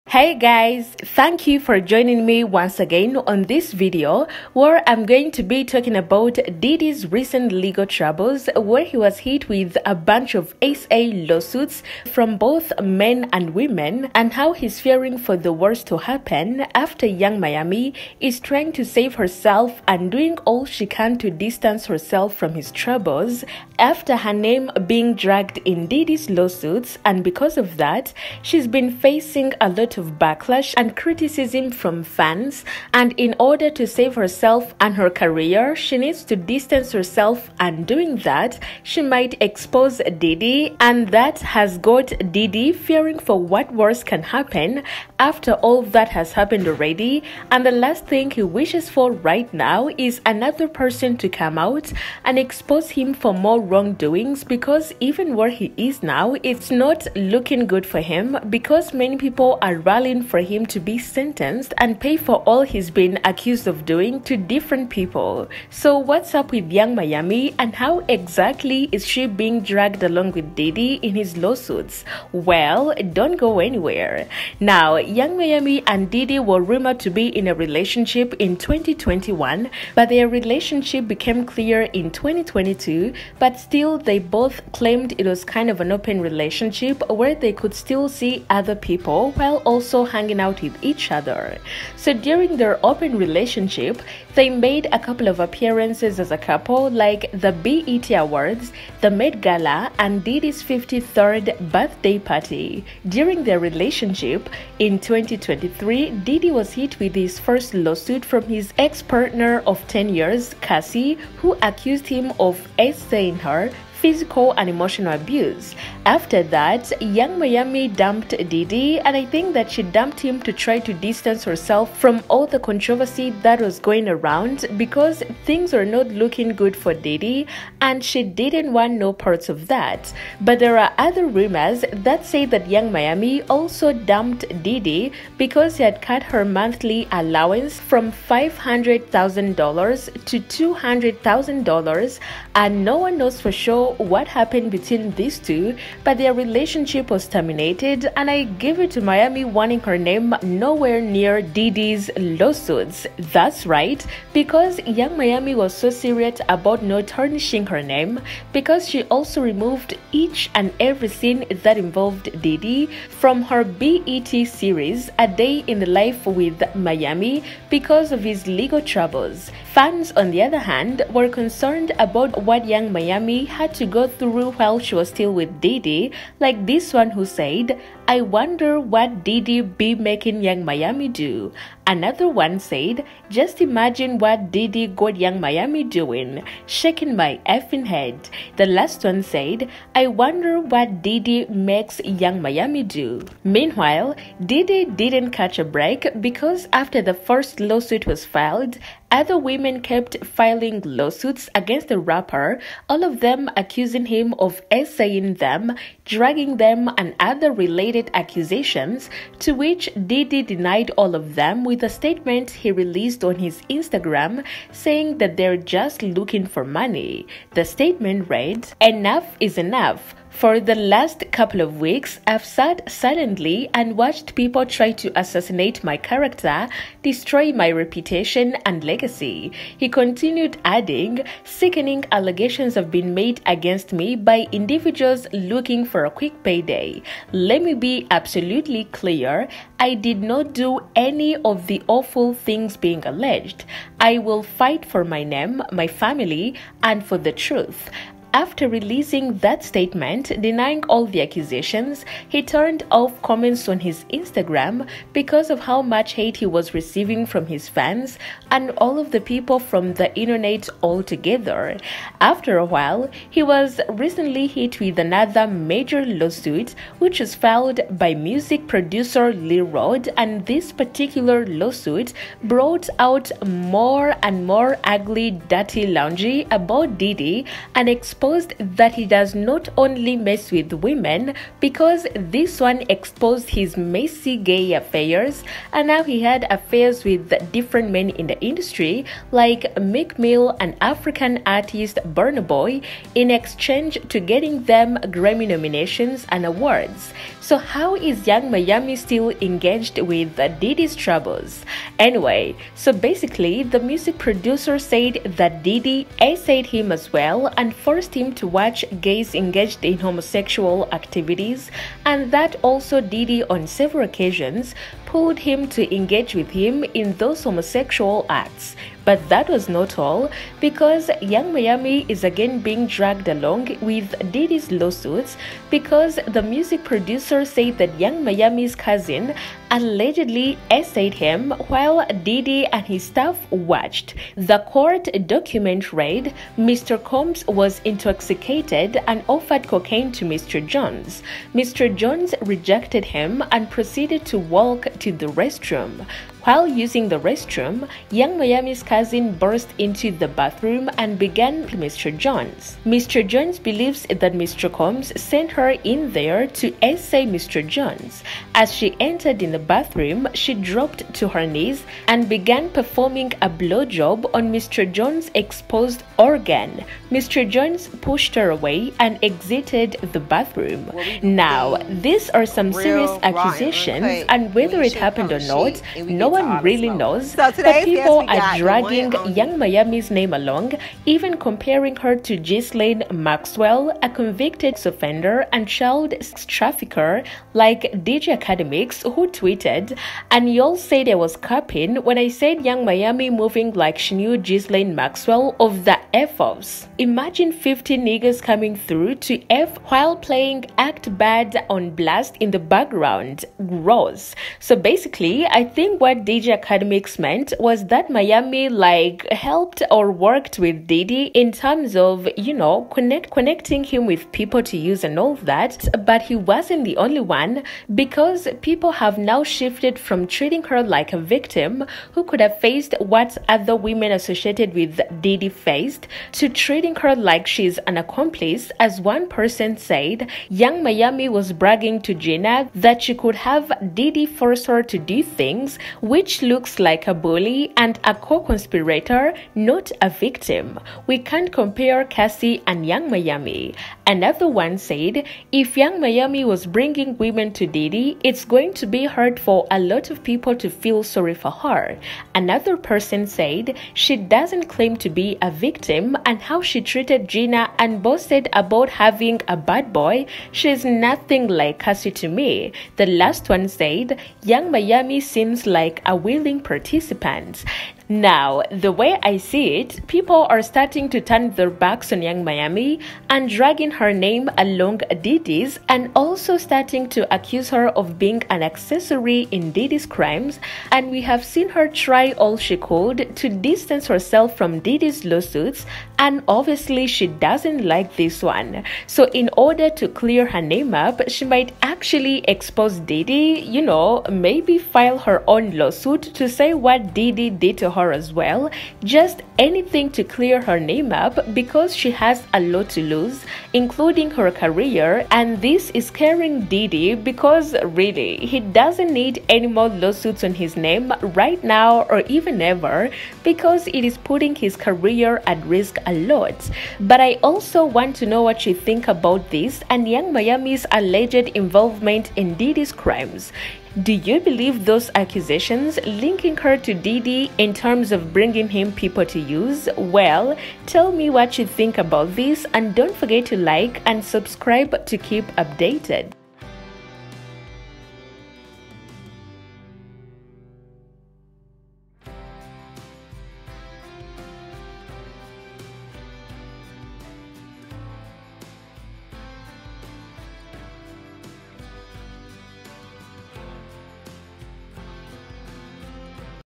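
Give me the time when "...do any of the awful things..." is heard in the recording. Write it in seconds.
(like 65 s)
240 s.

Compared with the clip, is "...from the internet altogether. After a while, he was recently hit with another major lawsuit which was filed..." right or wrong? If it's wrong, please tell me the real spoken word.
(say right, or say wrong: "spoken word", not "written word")
right.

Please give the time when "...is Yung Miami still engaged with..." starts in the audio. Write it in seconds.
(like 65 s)
297 s.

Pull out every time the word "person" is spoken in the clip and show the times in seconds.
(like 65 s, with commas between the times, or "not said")
50 s, 429 s, 452 s.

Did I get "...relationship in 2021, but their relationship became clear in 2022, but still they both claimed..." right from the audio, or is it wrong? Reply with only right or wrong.
right.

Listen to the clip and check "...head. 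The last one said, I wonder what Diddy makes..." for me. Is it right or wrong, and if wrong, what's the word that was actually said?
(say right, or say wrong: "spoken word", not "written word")
right.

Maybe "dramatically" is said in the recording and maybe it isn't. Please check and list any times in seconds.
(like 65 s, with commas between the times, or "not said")
not said.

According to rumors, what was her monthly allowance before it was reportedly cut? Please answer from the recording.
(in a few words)
$500,000.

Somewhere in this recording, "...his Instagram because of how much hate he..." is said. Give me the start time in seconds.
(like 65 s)
253 s.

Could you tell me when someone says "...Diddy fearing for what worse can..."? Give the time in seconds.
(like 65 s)
42 s.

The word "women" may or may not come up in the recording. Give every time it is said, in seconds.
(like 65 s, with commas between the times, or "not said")
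13 s, 199 s, 280 s, 423 s, 447 s.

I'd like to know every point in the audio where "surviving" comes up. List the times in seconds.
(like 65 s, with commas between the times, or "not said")
not said.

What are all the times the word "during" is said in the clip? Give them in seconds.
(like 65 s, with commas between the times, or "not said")
92 s, 103 s.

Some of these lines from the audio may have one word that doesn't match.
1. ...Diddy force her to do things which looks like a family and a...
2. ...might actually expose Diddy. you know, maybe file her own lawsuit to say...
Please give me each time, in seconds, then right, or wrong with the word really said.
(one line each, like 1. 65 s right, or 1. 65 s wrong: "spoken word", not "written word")
1. 433 s wrong: "bully", not "family"
2. 491 s right.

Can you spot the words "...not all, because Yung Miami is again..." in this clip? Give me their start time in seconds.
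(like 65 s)
319 s.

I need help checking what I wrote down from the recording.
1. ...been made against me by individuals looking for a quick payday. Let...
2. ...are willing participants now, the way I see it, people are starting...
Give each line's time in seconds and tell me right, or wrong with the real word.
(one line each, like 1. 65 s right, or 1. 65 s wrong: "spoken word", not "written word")
1. 232 s right
2. 466 s right.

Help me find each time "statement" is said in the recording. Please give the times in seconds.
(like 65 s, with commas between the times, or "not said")
211 s, 217 s, 249 s.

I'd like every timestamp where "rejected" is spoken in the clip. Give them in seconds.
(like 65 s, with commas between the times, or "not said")
342 s.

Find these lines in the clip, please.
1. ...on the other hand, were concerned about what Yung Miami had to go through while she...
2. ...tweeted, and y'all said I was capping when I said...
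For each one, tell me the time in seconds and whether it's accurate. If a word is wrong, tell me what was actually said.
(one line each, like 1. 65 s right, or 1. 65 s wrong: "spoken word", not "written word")
1. 170 s right
2. 389 s right.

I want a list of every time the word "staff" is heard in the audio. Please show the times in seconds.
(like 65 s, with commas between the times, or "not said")
333 s.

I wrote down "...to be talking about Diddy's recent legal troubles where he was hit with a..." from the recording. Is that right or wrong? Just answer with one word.
right.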